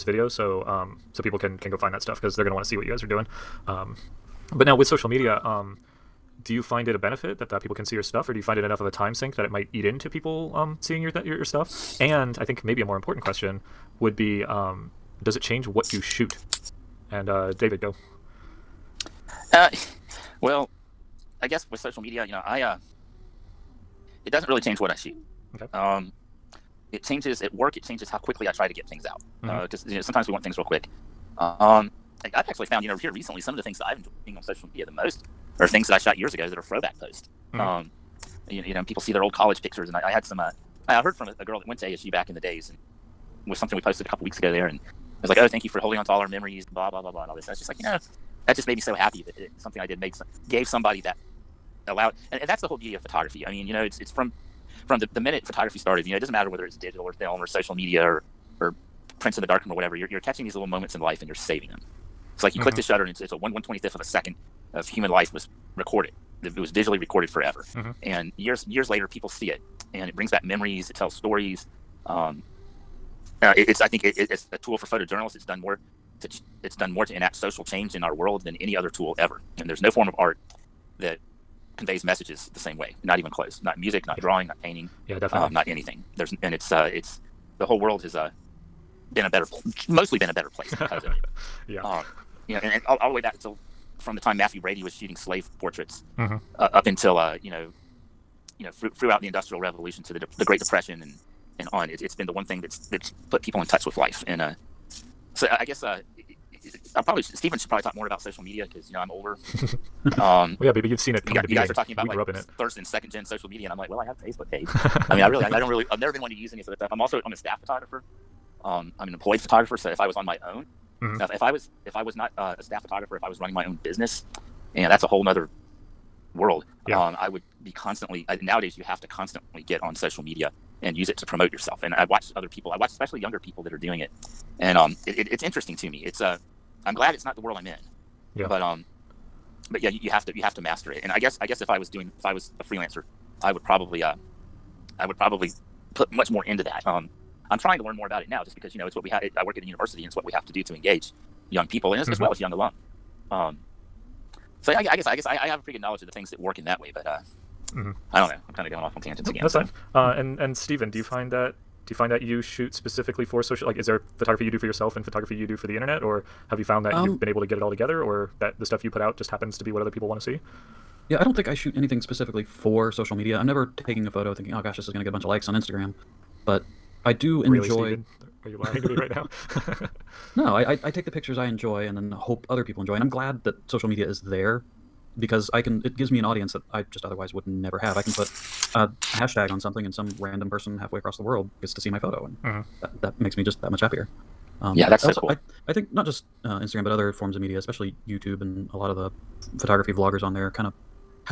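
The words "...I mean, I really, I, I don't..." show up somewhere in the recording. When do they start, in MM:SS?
01:55.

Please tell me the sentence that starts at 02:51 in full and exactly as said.
Yeah, I don't think I shoot anything specifically for social media.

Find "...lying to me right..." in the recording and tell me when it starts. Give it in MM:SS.
02:58.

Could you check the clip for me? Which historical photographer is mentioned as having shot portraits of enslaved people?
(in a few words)
Mathew Brady.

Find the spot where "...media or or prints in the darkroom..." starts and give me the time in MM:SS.
00:57.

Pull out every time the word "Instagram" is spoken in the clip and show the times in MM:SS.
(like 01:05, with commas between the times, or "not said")
02:55, 03:16.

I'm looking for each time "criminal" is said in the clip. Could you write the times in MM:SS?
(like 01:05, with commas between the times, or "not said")
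not said.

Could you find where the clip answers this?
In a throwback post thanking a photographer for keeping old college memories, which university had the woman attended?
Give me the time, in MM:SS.
00:41.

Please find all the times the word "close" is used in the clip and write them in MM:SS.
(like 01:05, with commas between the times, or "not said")
01:23.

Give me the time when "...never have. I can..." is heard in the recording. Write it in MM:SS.
03:07.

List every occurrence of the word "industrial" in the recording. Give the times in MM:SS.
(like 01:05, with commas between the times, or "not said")
01:39.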